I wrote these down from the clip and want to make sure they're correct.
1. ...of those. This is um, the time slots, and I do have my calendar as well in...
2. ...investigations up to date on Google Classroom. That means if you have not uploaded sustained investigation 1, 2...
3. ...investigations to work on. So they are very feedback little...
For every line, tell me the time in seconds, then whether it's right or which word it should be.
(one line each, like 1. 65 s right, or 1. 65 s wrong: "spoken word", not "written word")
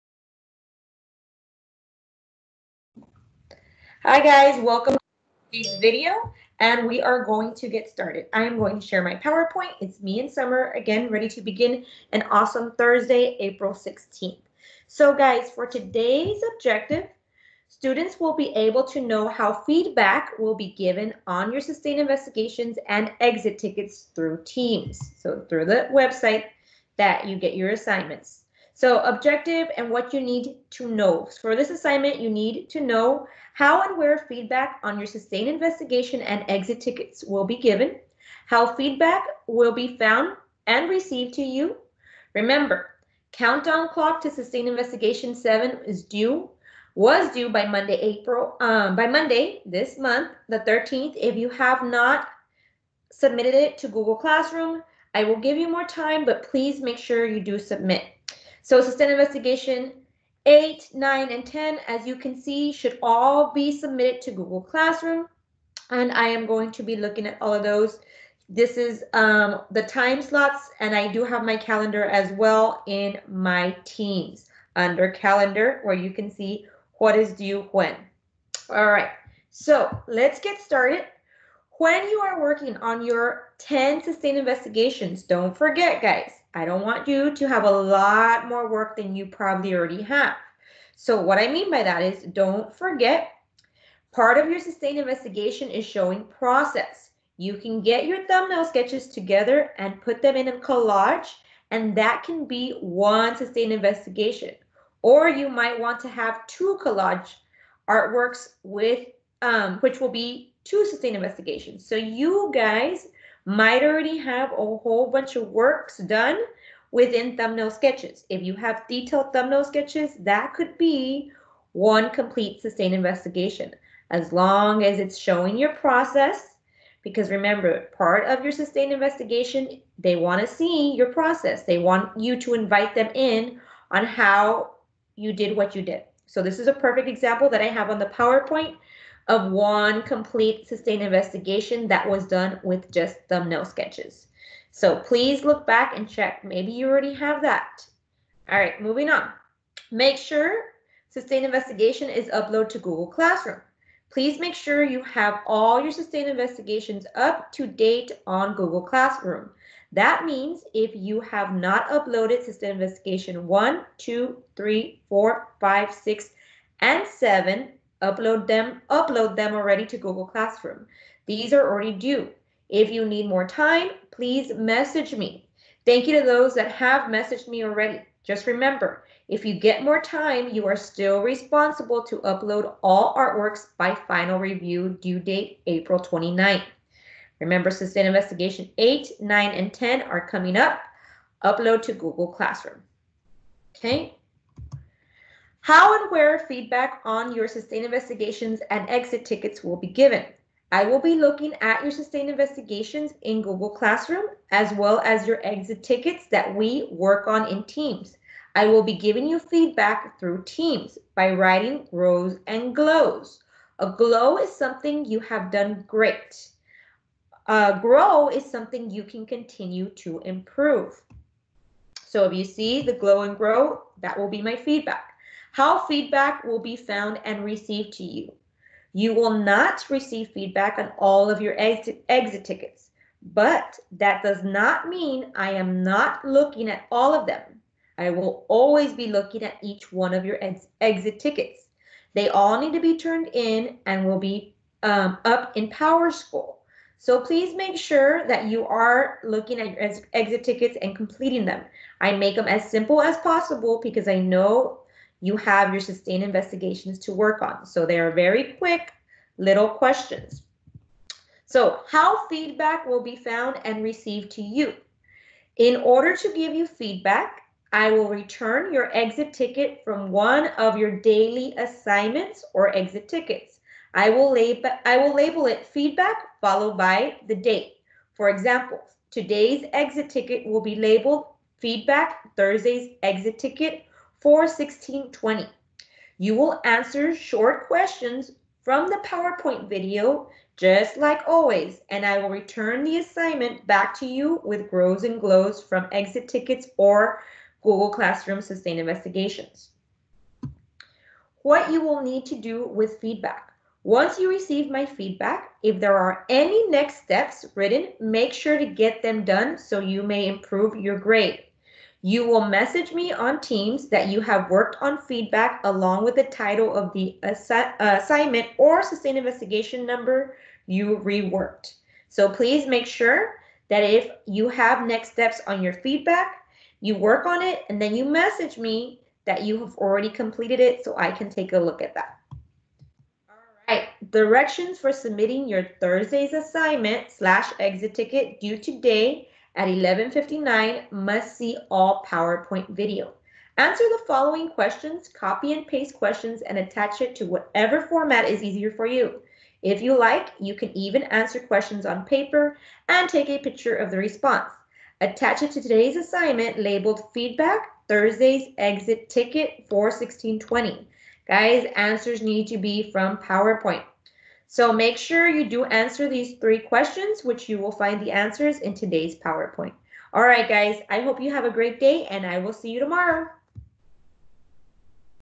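1. 67 s right
2. 156 s right
3. 256 s wrong: "quick", not "feedback".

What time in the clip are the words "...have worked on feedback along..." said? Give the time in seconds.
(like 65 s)
314 s.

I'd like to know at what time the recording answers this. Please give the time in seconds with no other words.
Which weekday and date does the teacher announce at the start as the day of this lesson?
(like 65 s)
12 s.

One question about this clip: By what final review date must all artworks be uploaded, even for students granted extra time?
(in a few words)
April 29th.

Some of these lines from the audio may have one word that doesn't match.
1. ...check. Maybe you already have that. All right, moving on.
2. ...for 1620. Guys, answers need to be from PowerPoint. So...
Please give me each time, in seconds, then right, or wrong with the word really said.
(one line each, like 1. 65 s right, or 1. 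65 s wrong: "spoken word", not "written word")
1. 146 s right
2. 359 s right.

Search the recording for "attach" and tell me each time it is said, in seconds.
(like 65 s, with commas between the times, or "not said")
346 s, 355 s.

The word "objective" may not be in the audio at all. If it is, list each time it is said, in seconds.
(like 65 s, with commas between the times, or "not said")
16 s, 29 s.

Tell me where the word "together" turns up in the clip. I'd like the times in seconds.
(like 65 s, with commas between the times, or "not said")
99 s.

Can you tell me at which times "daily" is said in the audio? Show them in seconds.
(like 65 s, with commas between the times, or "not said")
271 s.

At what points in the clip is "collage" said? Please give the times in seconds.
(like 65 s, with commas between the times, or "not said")
100 s, 106 s.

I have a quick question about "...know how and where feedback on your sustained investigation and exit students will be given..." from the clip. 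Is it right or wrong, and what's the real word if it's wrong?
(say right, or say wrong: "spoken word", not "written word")
wrong: "tickets", not "students".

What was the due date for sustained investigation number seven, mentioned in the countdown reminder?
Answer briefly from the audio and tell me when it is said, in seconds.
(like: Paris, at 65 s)
Monday, April 13th, at 50 s.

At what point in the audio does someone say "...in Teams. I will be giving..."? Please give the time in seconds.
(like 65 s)
207 s.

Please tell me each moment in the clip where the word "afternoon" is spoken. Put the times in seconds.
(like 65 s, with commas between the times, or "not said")
not said.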